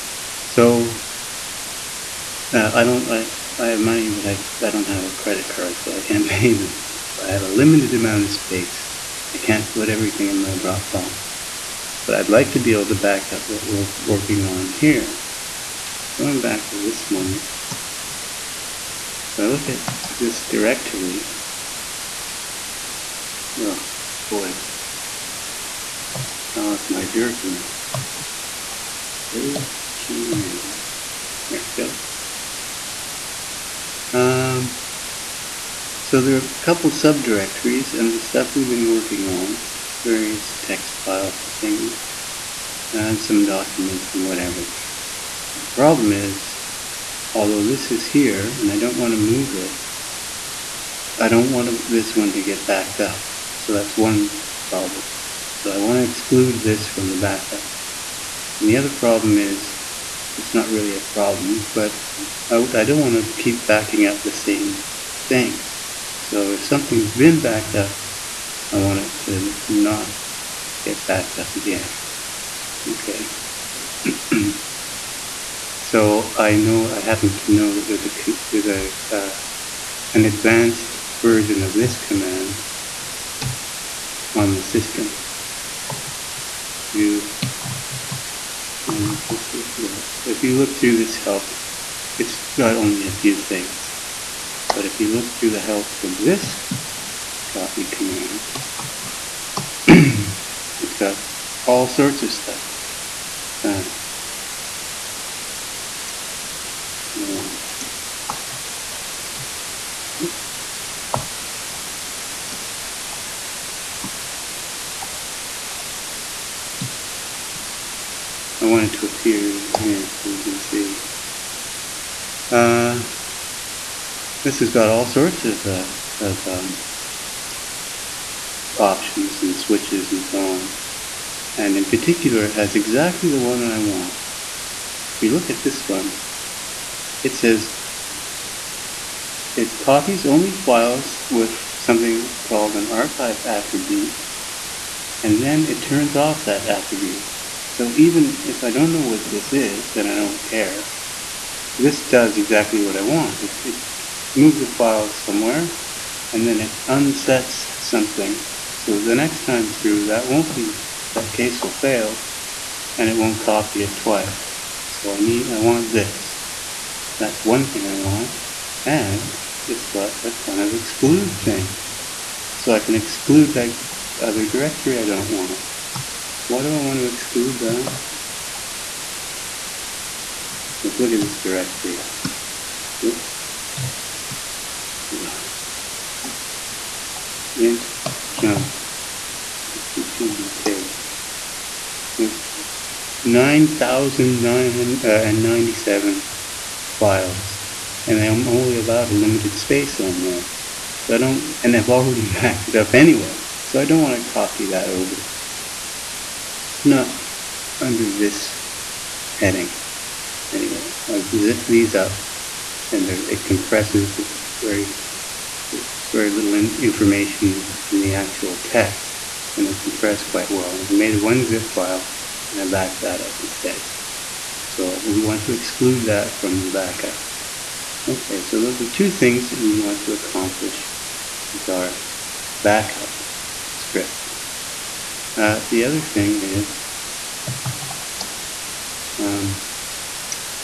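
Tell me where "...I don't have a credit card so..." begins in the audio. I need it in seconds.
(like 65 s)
4 s.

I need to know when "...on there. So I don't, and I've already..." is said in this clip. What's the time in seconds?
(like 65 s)
200 s.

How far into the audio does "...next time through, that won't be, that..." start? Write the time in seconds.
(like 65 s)
159 s.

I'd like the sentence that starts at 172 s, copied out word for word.
So I can exclude that other directory I don't want.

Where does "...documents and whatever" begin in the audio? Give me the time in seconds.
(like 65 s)
43 s.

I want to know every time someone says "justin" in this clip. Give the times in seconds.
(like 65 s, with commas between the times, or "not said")
not said.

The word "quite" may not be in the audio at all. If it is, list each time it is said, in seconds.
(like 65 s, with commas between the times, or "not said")
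220 s.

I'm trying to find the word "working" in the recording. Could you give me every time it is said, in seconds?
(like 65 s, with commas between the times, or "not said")
13 s, 38 s.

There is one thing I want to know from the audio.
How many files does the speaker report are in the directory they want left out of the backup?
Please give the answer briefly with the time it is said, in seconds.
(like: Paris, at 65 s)
9,997, at 193 s.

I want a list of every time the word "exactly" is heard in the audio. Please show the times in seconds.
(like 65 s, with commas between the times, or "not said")
132 s, 152 s.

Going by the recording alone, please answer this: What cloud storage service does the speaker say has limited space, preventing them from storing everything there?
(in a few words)
Dropbox.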